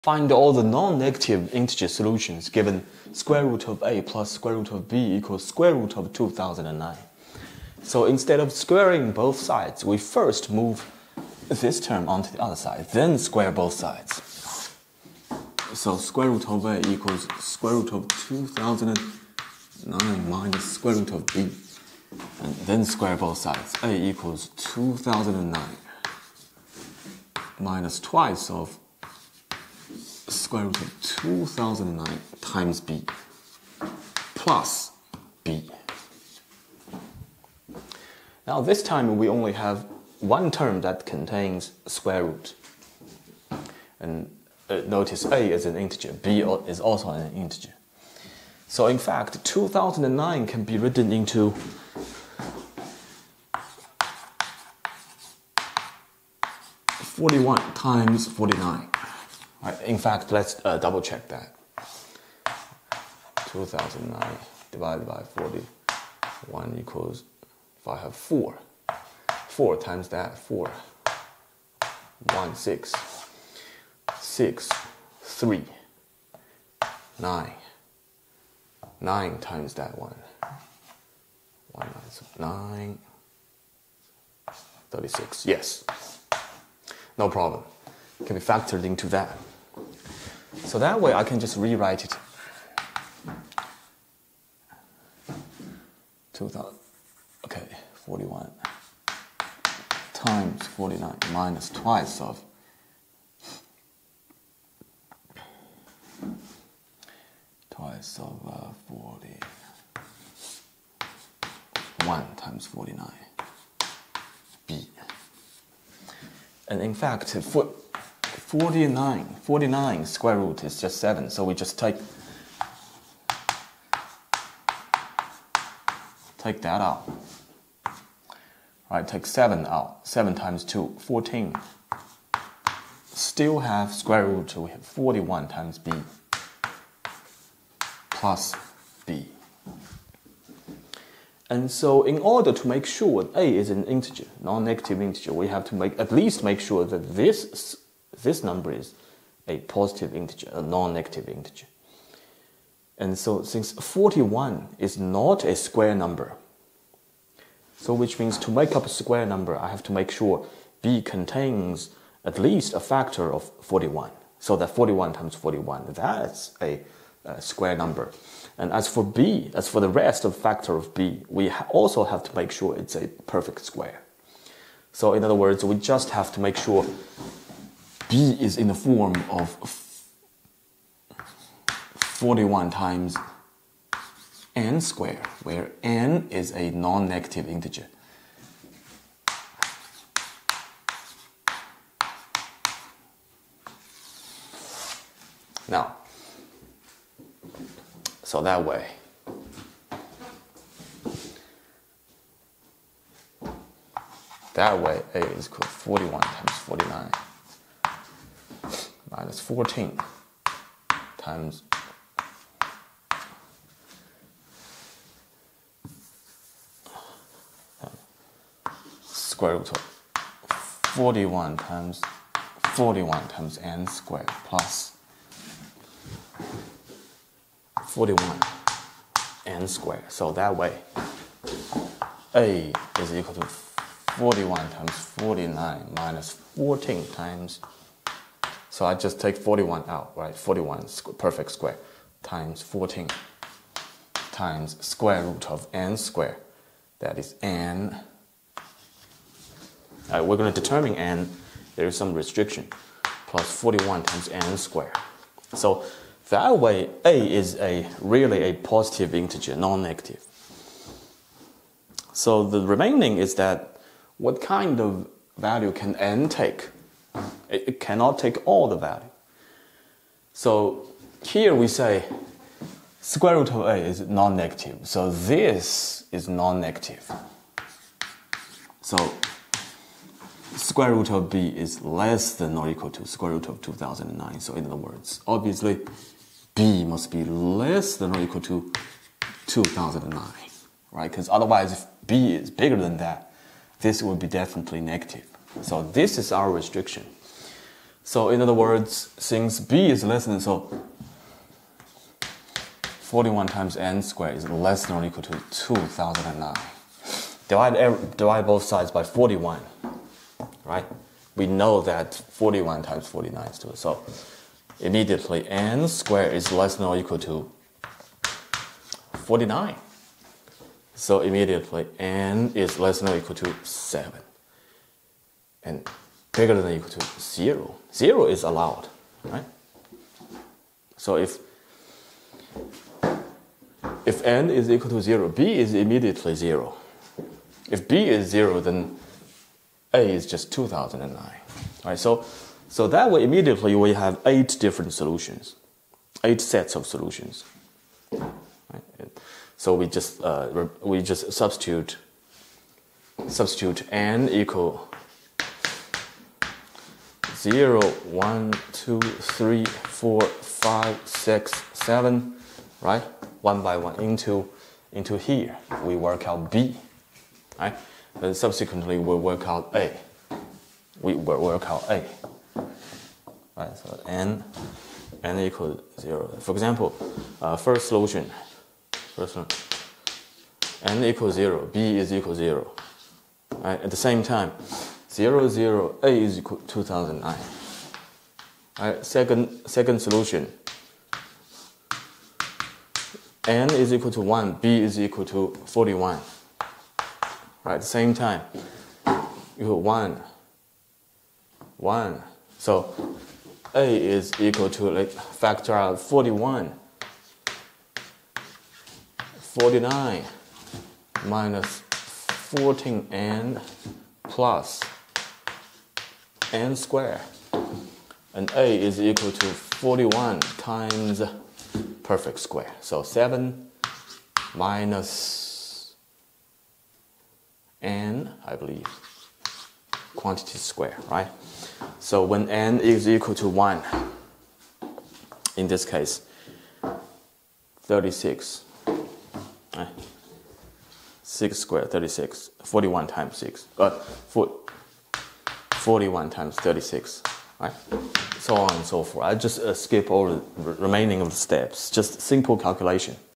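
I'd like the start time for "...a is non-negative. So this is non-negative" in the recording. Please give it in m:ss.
4:33.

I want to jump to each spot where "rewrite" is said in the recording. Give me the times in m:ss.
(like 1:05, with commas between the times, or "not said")
1:31.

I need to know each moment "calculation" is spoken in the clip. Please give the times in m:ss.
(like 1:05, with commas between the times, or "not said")
7:32.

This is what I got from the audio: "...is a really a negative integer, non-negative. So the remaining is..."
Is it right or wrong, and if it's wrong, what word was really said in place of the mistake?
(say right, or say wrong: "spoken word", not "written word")
wrong: "positive", not "negative".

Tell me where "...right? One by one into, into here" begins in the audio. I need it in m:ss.
6:02.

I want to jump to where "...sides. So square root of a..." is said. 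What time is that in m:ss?
0:13.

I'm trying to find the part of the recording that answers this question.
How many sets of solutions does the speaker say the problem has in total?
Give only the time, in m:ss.
5:46.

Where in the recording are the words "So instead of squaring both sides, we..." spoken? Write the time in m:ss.
0:07.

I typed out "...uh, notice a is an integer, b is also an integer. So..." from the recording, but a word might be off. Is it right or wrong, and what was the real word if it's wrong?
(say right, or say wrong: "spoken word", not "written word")
right.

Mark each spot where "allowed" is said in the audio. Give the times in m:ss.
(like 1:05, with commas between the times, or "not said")
5:28.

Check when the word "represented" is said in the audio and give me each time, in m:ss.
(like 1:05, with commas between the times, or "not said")
not said.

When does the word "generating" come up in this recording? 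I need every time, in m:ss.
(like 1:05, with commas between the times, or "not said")
not said.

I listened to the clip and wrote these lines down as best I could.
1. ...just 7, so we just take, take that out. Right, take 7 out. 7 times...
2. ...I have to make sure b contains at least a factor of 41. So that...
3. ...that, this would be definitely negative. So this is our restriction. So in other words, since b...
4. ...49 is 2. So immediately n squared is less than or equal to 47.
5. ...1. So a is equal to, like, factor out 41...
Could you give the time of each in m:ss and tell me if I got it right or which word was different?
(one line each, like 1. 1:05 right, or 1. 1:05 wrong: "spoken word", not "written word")
1. 2:00 right
2. 2:39 right
3. 4:52 right
4. 5:13 wrong: "49", not "47"
5. 6:41 right.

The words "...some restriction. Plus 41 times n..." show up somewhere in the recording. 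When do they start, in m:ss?
4:11.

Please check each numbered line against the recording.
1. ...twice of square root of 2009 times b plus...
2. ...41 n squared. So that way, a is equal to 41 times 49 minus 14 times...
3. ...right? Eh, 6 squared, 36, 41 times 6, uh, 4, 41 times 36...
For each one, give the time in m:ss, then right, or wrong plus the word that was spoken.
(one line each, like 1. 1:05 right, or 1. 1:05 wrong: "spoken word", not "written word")
1. 0:27 right
2. 3:47 right
3. 7:19 right.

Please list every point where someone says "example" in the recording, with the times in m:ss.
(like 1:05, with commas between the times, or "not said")
6:16.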